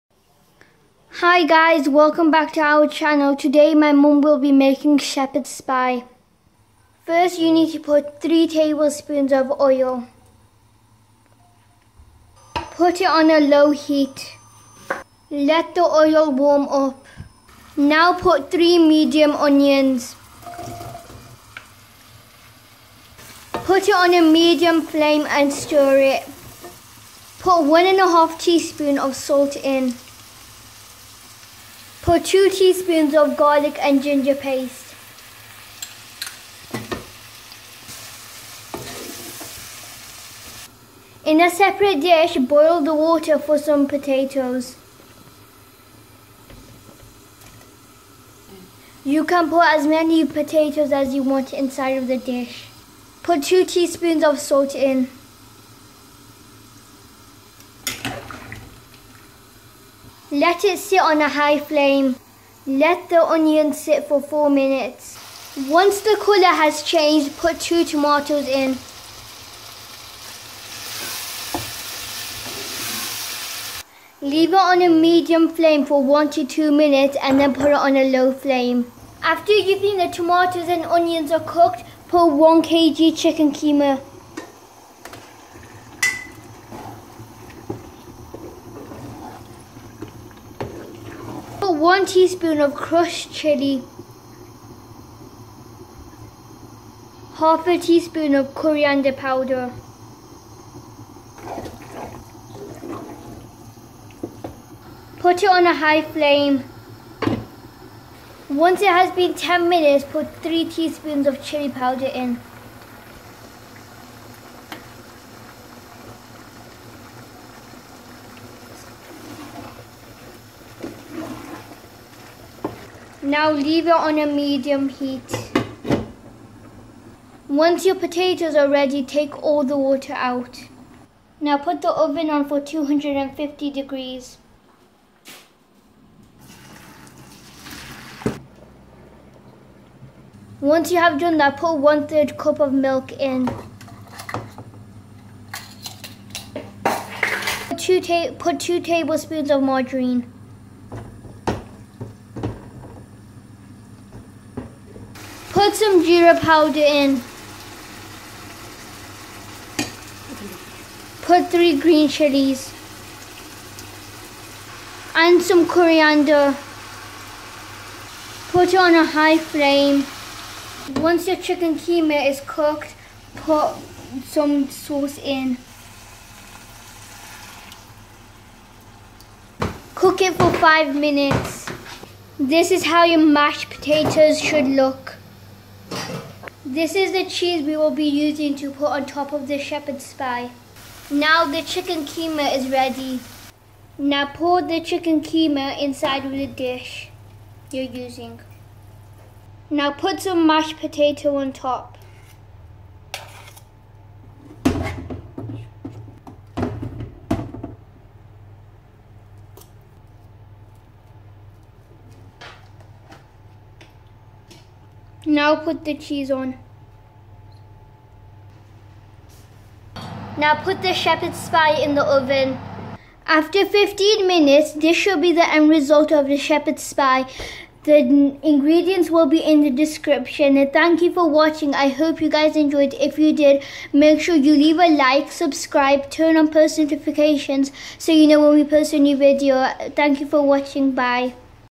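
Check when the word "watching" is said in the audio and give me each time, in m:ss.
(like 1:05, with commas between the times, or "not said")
3:51, 4:00.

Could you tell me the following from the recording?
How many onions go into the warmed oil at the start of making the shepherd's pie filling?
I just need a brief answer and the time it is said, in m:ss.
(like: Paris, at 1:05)
3 medium onions, at 0:18.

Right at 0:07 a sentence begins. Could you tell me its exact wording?
First you need to put 3 tablespoons of oil.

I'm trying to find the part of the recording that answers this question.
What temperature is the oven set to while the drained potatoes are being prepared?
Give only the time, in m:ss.
2:12.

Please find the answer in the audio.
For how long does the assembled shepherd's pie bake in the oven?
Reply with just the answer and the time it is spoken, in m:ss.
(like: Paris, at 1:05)
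15 minutes, at 3:43.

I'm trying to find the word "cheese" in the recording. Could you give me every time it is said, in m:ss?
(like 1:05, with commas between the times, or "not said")
3:07, 3:35.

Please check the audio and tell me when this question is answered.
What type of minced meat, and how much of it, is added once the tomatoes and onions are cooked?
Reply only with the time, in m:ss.
1:22.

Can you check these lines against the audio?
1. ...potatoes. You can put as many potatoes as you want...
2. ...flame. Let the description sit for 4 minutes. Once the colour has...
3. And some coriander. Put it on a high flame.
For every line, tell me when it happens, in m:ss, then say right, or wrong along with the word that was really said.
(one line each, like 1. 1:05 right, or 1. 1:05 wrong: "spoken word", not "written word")
1. 0:43 right
2. 1:01 wrong: "onion", not "description"
3. 2:45 right.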